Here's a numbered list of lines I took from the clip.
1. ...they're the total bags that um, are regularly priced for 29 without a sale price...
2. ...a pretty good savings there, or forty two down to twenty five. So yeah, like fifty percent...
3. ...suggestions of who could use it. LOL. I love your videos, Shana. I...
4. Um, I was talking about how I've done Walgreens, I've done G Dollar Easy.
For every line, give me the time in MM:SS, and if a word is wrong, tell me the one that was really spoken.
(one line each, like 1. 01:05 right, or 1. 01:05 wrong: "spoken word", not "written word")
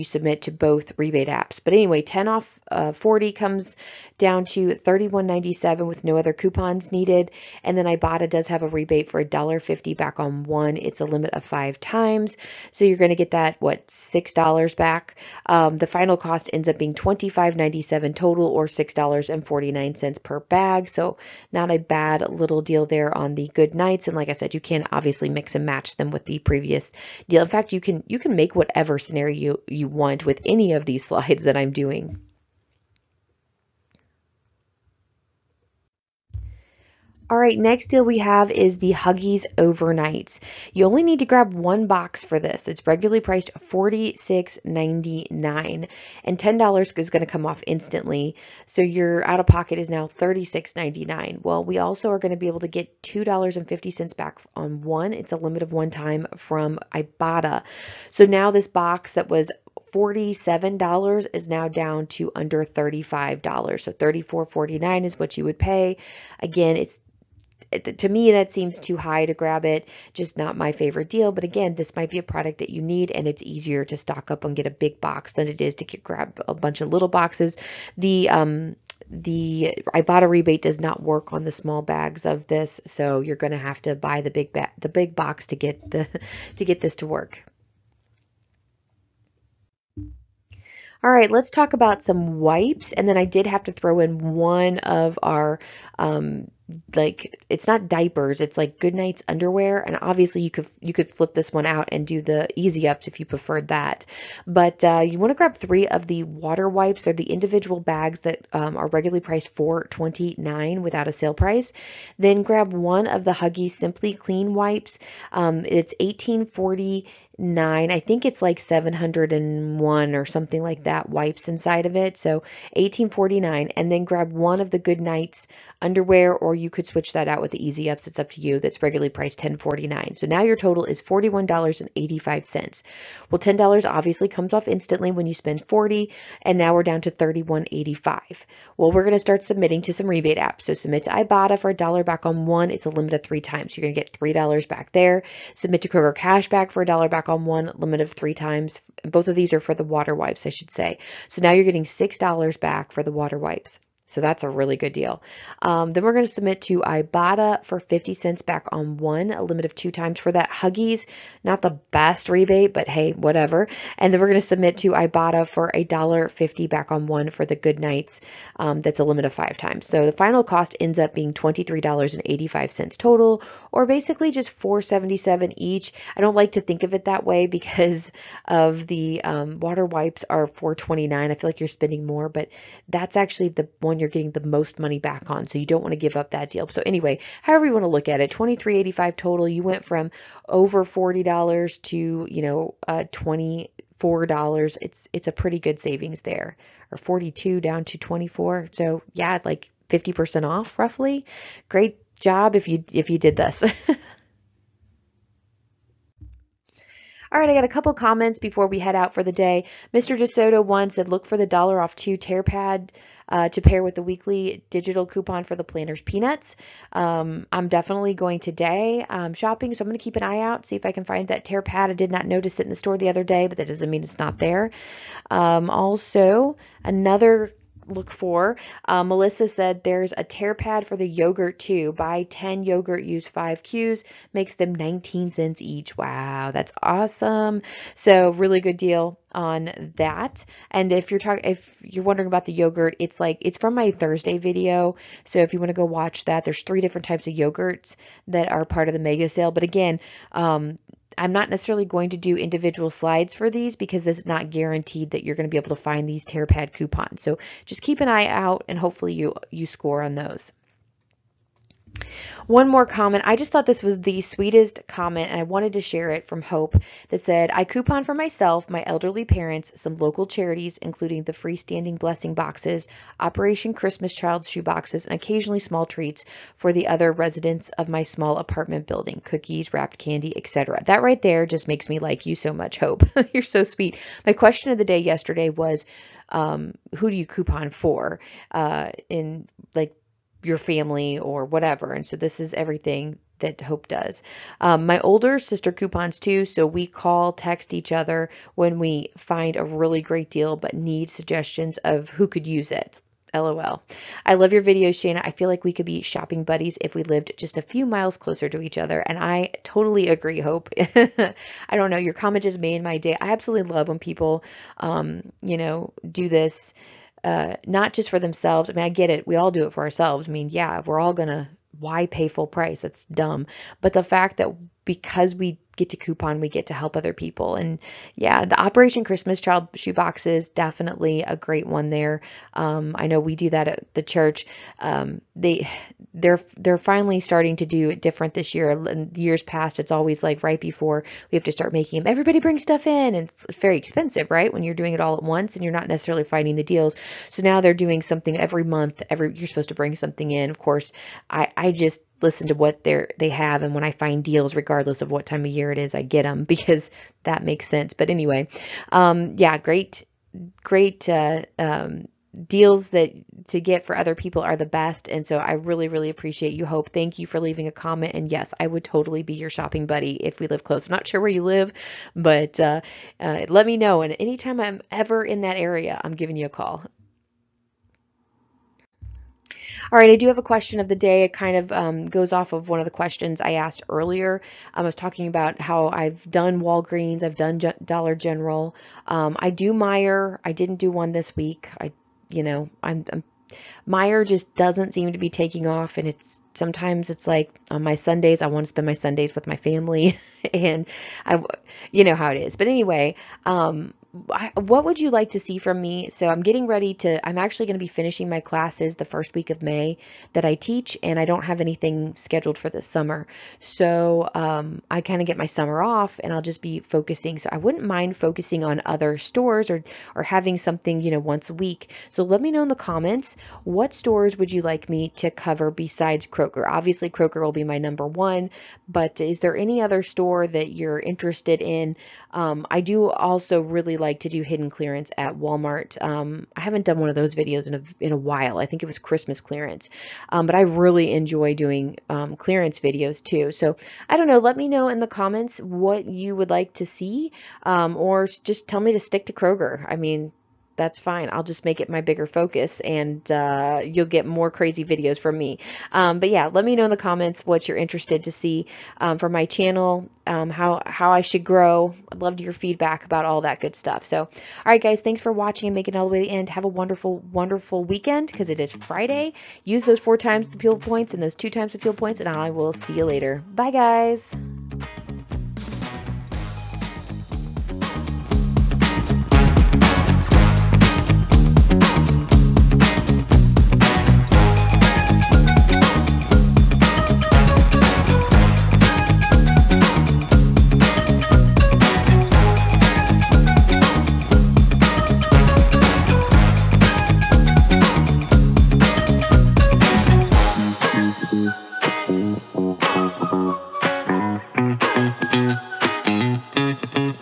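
1. 01:47 wrong: "individual", not "total"
2. 03:15 wrong: "four", not "five"
3. 05:01 right
4. 06:24 wrong: "General", not "Easy".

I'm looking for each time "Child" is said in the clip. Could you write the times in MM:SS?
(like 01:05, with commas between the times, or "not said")
04:34, 05:29.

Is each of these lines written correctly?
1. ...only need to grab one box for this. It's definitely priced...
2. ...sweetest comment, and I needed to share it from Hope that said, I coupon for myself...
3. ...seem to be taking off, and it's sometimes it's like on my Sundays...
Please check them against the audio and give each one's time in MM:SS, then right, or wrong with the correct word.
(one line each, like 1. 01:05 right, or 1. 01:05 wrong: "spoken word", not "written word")
1. 00:40 wrong: "regularly", not "definitely"
2. 04:24 wrong: "wanted", not "needed"
3. 06:34 right.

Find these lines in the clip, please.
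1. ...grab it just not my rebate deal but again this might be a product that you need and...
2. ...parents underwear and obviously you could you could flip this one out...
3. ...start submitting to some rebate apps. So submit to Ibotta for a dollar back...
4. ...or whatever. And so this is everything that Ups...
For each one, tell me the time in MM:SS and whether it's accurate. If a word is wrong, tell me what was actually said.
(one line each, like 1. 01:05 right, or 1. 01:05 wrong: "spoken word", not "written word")
1. 01:09 wrong: "favorite", not "rebate"
2. 01:38 wrong: "nights", not "parents"
3. 02:19 right
4. 04:51 wrong: "Hope", not "Ups".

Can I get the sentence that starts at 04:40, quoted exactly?
That right there just makes me like you so much, Hope.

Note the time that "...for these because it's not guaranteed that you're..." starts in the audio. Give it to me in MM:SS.
04:13.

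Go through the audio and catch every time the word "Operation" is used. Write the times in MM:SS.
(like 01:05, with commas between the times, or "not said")
04:33, 05:28.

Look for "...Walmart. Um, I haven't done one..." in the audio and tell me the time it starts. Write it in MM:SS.
07:15.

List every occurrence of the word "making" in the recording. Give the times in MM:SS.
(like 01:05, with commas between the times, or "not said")
05:41, 07:45.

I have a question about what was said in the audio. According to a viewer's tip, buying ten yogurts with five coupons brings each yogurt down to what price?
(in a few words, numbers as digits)
19 cents.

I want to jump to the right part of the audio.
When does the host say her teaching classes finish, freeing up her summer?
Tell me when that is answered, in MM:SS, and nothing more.
06:49.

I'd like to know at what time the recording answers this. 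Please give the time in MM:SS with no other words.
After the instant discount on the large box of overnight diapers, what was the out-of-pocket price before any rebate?
00:50.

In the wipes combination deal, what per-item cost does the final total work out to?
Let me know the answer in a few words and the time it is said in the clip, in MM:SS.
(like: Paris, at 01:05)
$4.77, at 02:54.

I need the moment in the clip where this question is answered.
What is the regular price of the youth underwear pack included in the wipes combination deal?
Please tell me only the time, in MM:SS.
02:09.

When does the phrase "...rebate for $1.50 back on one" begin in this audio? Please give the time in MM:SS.
00:08.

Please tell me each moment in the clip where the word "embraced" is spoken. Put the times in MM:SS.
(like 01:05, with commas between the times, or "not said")
not said.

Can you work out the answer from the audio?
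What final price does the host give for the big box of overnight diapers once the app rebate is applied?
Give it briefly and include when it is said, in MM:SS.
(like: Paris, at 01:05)
$34.49, at 01:03.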